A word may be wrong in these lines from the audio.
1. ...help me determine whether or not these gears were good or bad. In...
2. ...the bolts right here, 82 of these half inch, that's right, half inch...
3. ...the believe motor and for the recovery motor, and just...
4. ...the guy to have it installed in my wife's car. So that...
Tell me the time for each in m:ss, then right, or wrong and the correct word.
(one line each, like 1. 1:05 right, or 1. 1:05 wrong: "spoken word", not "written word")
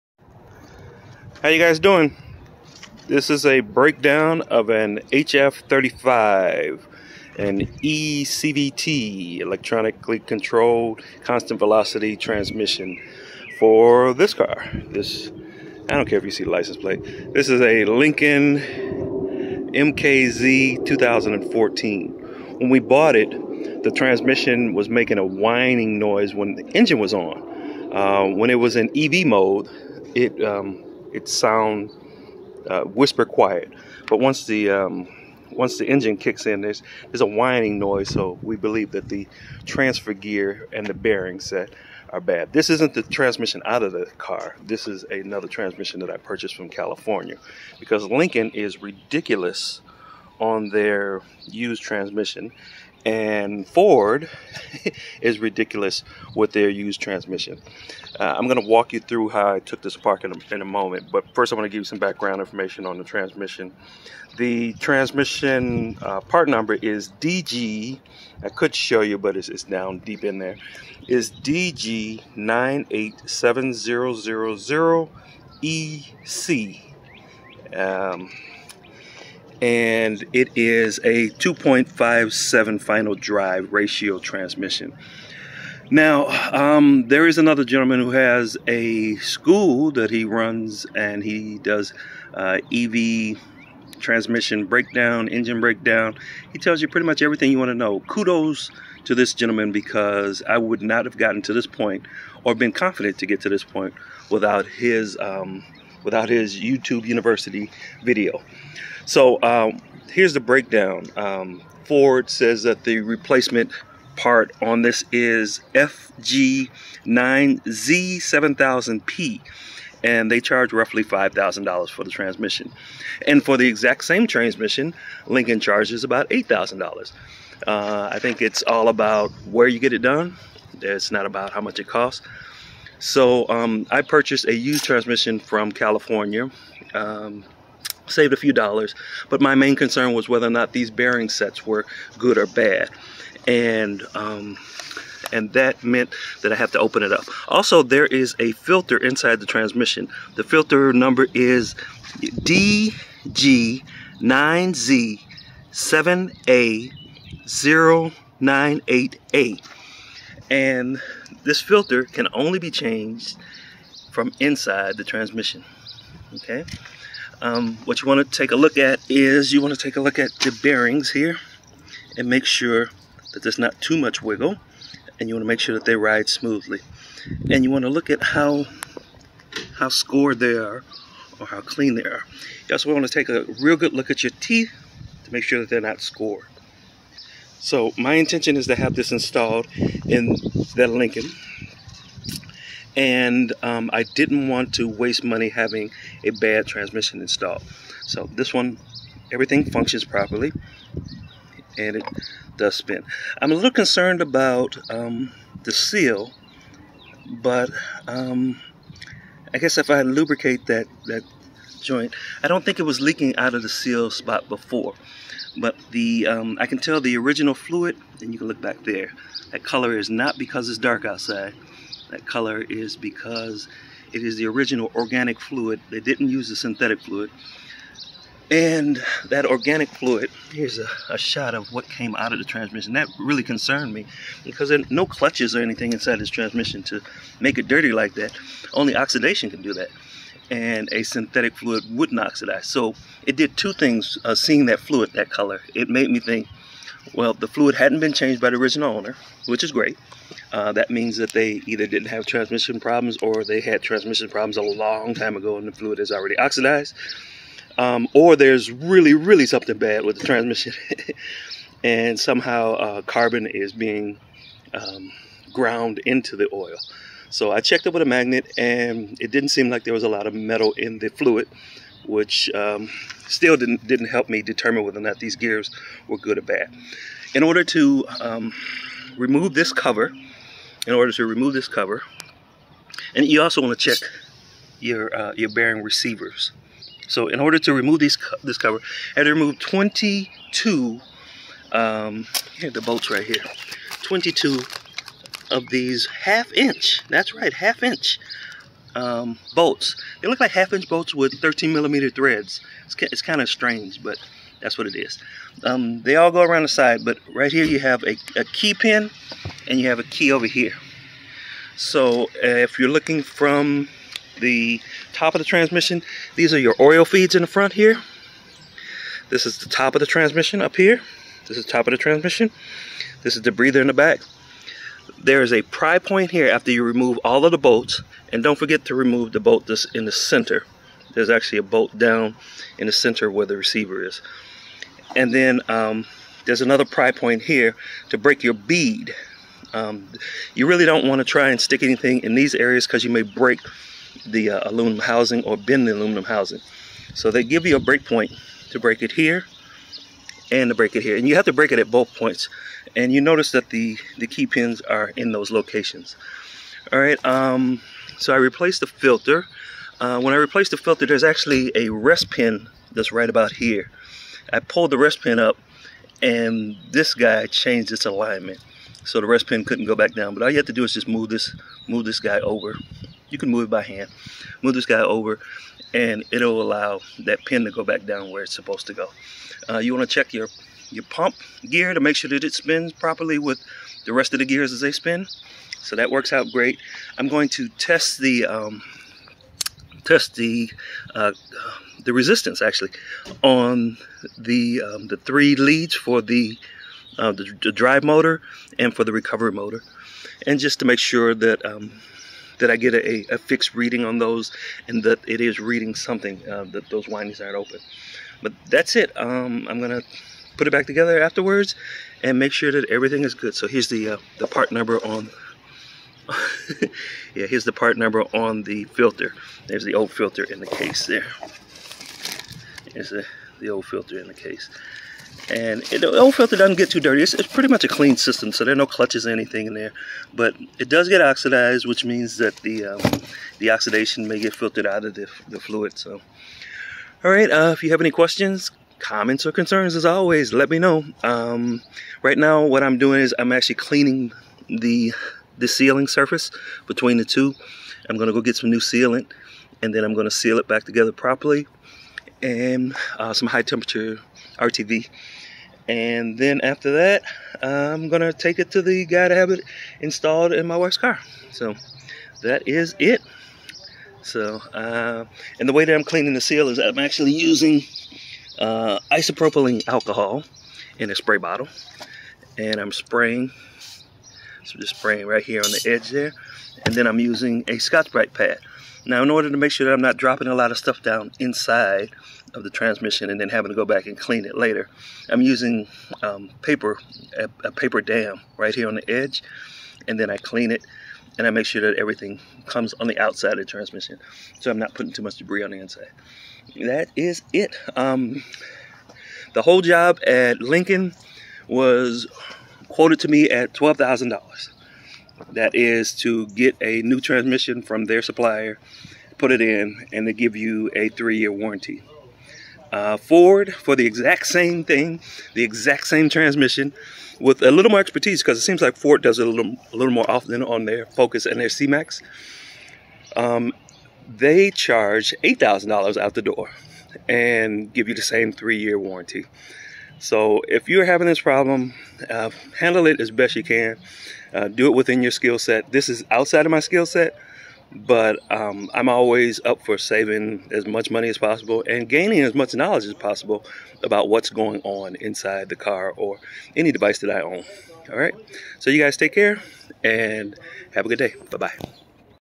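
1. 4:34 right
2. 4:52 wrong: "22", not "82"
3. 6:37 wrong: "drive", not "believe"
4. 7:38 right.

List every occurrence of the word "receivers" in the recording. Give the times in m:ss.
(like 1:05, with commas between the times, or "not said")
4:45, 5:33.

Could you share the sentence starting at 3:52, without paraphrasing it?
That really concerned me because there no clutches or anything inside this transmission to make it dirty like that.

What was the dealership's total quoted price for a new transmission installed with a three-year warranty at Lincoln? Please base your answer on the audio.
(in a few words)
$12,000.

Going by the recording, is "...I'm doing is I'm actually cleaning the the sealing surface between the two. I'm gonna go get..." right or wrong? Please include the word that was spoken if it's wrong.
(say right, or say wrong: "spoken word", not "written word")
right.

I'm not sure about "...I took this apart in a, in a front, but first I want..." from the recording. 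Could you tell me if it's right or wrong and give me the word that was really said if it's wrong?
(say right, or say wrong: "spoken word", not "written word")
wrong: "moment", not "front".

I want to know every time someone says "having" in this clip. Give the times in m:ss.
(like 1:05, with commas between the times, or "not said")
3:15, 8:03, 8:51.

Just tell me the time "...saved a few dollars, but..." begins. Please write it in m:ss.
2:18.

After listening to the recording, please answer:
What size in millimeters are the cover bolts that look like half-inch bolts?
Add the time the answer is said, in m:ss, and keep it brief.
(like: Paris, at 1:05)
13 millimeter, at 5:01.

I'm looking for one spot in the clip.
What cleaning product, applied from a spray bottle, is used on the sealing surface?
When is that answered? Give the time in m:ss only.
7:49.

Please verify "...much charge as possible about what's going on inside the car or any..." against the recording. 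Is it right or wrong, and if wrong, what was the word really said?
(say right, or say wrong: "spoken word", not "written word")
wrong: "knowledge", not "charge".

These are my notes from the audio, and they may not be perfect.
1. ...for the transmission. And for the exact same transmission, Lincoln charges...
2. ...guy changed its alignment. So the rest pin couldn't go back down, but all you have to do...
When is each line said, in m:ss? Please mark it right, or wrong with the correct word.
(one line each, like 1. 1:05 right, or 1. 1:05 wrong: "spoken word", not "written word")
1. 2:01 right
2. 6:07 right.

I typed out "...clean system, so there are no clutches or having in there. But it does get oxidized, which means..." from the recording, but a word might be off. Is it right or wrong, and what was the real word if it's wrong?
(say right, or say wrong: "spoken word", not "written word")
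wrong: "anything", not "having".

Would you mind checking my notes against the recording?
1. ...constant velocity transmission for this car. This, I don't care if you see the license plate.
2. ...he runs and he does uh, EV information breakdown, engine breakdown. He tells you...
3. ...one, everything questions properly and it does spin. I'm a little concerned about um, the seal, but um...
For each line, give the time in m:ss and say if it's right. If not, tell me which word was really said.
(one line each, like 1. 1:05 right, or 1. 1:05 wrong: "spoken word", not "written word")
1. 0:11 right
2. 1:30 wrong: "transmission", not "information"
3. 3:18 wrong: "functions", not "questions".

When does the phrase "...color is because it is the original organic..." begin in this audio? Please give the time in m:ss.
3:42.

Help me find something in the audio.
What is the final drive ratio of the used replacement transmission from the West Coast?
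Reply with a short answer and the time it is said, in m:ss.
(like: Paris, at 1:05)
2.57, at 1:21.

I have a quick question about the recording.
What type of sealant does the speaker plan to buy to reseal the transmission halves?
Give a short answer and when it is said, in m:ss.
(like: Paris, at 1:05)
high temperature RTV, at 7:33.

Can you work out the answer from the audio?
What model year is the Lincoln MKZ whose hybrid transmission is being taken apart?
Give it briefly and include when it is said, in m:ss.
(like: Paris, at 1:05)
2014, at 0:20.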